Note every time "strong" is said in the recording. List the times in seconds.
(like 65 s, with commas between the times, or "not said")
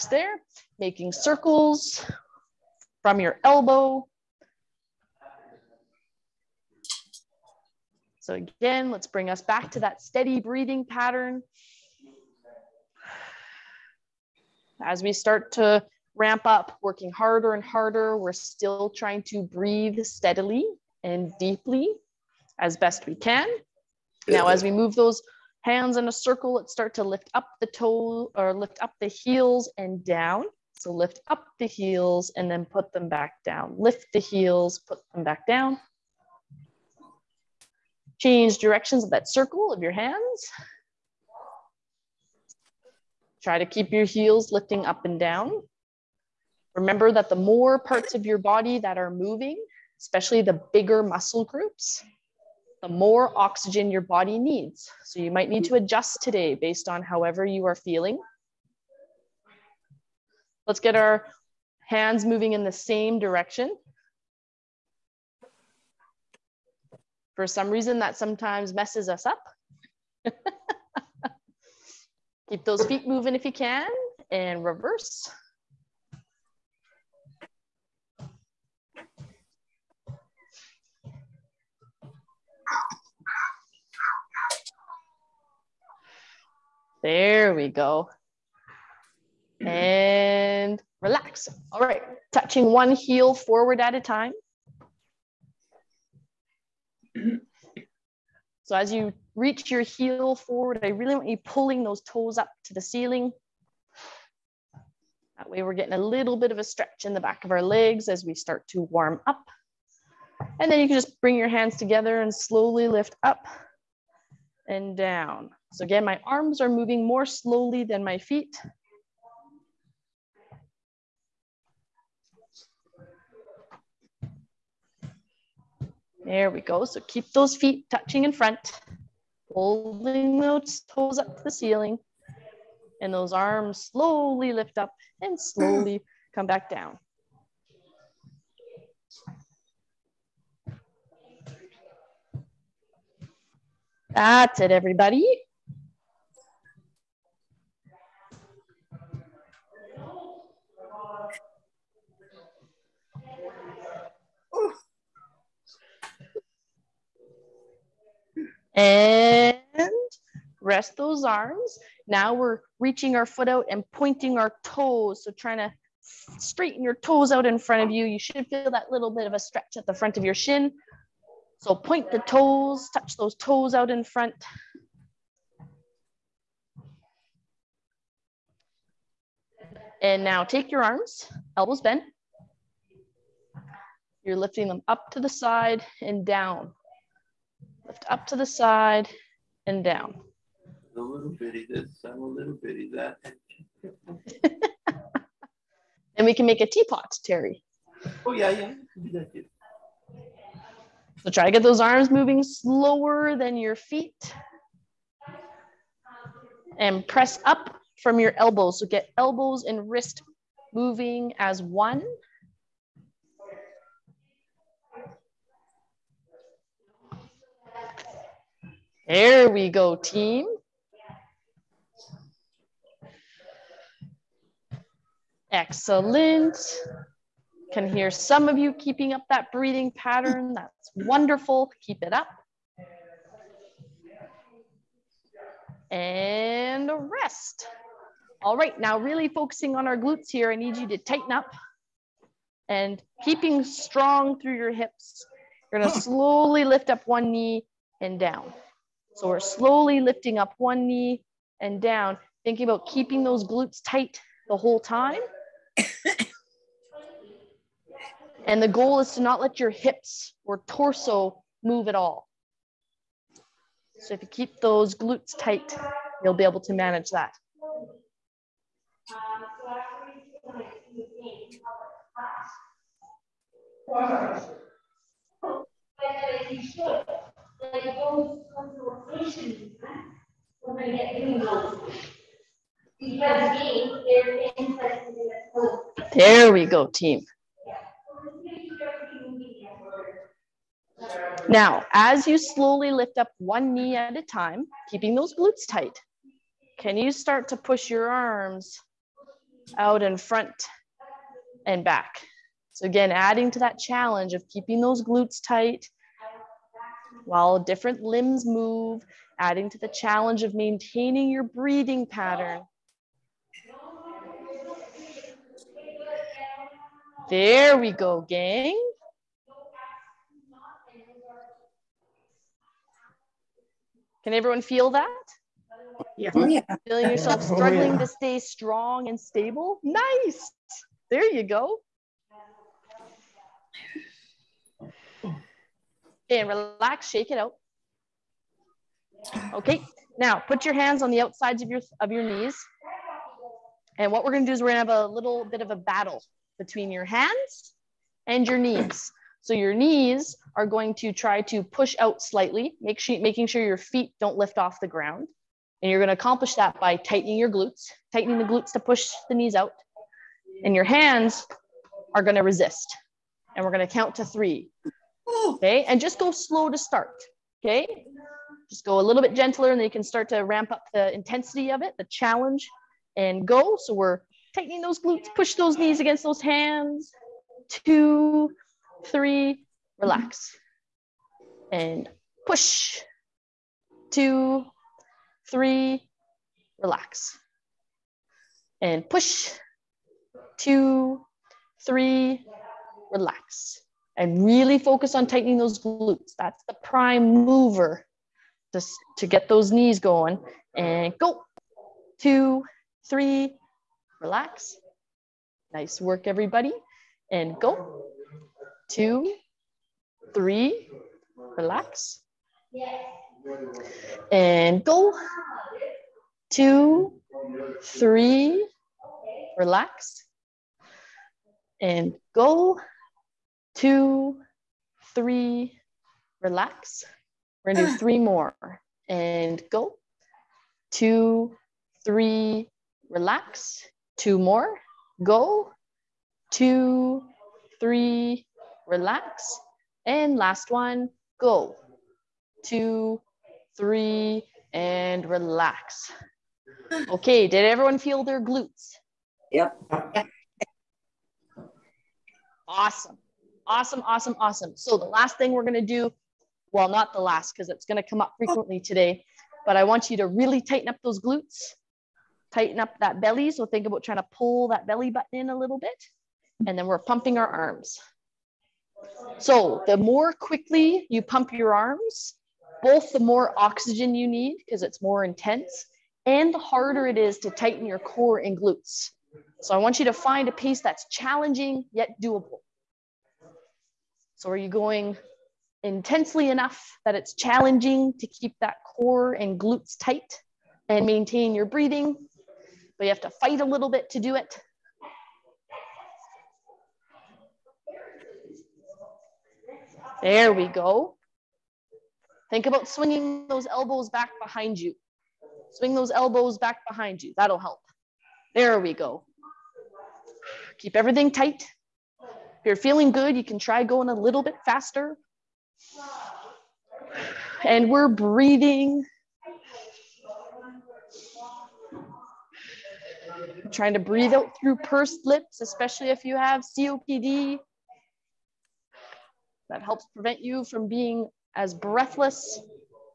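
243 s, 328 s.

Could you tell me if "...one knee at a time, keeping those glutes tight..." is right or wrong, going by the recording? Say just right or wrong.
right.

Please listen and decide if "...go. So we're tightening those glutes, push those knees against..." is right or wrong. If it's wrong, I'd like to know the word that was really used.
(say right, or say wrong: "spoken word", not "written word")
right.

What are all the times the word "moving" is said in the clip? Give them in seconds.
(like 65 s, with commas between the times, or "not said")
49 s, 62 s, 73 s, 116 s, 202 s, 210 s.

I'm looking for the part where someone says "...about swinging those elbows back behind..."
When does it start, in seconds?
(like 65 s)
502 s.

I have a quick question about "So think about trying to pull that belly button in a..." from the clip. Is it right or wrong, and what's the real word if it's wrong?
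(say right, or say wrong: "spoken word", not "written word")
right.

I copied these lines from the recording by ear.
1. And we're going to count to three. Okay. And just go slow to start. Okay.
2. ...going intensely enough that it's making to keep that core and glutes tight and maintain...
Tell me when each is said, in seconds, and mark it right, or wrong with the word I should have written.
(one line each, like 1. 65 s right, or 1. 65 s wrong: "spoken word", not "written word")
1. 363 s right
2. 484 s wrong: "challenging", not "making".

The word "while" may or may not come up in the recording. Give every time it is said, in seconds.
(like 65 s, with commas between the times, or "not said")
307 s.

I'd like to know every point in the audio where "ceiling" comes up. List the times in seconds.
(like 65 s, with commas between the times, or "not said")
102 s, 131 s.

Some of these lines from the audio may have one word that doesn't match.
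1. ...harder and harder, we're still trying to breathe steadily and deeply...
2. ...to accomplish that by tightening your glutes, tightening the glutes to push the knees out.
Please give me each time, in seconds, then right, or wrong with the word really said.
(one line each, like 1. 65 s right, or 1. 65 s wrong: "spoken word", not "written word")
1. 17 s right
2. 356 s right.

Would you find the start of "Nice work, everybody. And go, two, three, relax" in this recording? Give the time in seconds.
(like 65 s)
405 s.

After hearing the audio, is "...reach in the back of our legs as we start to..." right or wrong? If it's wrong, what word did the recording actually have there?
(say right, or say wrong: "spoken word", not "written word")
wrong: "stretch", not "reach".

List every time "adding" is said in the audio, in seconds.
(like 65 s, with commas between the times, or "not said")
303 s, 309 s.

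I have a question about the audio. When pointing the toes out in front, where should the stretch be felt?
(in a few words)
front of your shin.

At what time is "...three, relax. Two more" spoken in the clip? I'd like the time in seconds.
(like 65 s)
432 s.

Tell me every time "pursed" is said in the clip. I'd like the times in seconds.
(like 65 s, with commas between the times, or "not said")
524 s.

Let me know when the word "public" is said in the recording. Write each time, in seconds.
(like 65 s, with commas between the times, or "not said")
not said.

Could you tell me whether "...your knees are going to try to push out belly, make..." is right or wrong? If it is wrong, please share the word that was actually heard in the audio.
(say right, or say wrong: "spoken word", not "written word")
wrong: "slightly", not "belly".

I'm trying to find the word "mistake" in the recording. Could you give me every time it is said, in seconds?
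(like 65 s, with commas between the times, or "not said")
not said.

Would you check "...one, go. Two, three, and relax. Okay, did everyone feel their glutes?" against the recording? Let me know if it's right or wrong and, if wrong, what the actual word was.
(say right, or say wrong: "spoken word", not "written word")
right.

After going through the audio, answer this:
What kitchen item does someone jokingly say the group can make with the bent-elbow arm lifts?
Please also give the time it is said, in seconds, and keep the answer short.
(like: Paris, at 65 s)
teapot, at 196 s.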